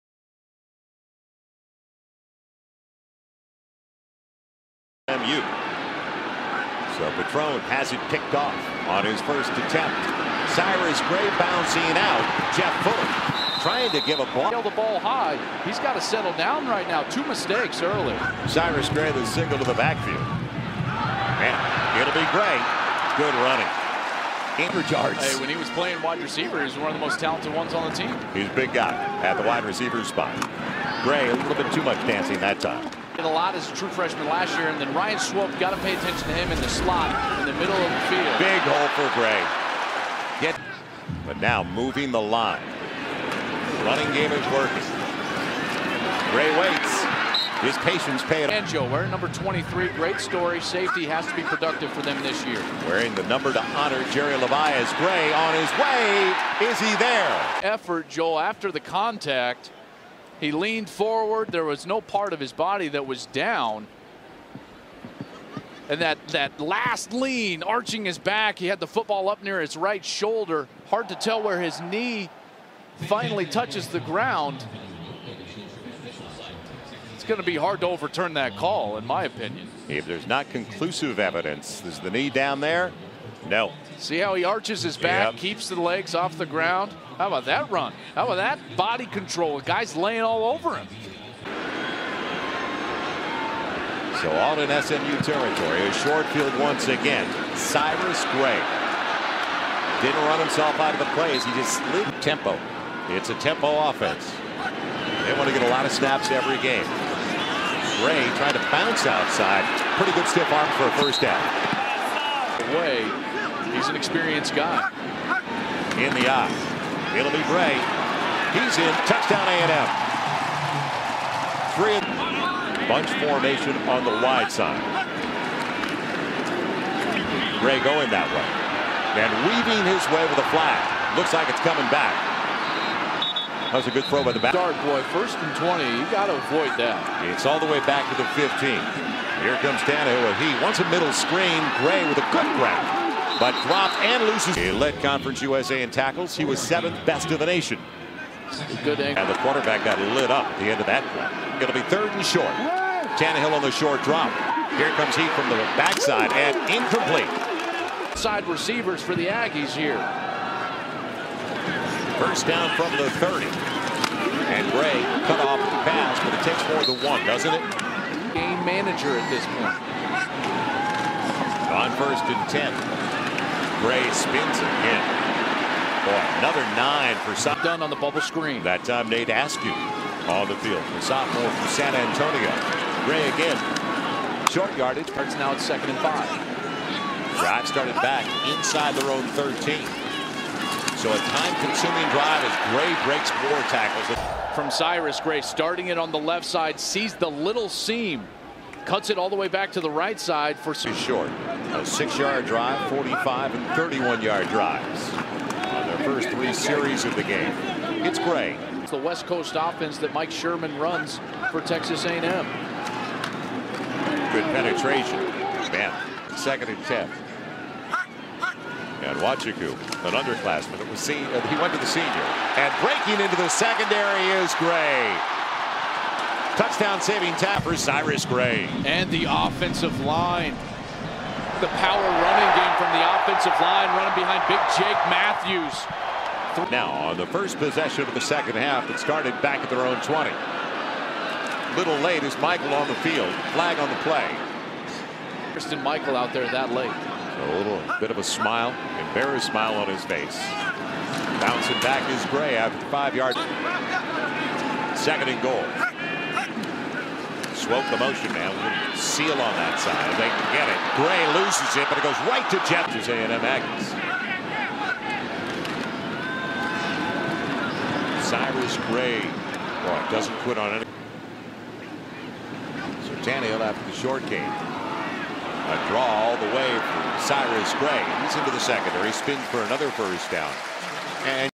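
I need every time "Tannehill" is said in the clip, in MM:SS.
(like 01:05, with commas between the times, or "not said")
02:19, 02:33.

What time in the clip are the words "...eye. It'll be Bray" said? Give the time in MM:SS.
01:56.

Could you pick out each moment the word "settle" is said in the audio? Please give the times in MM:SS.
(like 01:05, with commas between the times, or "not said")
00:16.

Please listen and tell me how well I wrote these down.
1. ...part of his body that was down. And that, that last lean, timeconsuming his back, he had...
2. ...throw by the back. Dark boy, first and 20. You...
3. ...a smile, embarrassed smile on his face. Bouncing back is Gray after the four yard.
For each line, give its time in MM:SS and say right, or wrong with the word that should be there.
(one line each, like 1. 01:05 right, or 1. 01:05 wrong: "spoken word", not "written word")
1. 01:02 wrong: "arching", not "timeconsuming"
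2. 02:14 right
3. 04:08 wrong: "five", not "four".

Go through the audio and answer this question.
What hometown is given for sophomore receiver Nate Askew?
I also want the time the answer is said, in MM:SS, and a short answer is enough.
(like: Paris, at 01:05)
San Antonio, at 03:01.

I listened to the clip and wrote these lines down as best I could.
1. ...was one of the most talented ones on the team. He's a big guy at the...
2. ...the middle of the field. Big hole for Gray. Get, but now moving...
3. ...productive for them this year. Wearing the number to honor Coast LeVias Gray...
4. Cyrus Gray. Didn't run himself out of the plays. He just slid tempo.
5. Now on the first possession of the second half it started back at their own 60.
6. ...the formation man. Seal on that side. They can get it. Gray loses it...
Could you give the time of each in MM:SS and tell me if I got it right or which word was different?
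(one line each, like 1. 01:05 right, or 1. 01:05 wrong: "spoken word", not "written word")
1. 00:26 right
2. 00:37 right
3. 00:51 wrong: "Jerry", not "Coast"
4. 01:37 right
5. 03:56 wrong: "20", not "60"
6. 04:17 wrong: "motion", not "formation".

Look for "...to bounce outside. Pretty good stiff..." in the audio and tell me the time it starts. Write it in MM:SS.
01:48.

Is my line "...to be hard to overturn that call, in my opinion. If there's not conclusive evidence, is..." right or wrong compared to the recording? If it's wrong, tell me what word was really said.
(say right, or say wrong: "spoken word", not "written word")
right.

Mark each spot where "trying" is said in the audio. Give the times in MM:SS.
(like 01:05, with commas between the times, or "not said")
00:13, 01:48.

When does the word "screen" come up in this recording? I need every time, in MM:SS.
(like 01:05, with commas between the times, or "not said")
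02:21, 02:58.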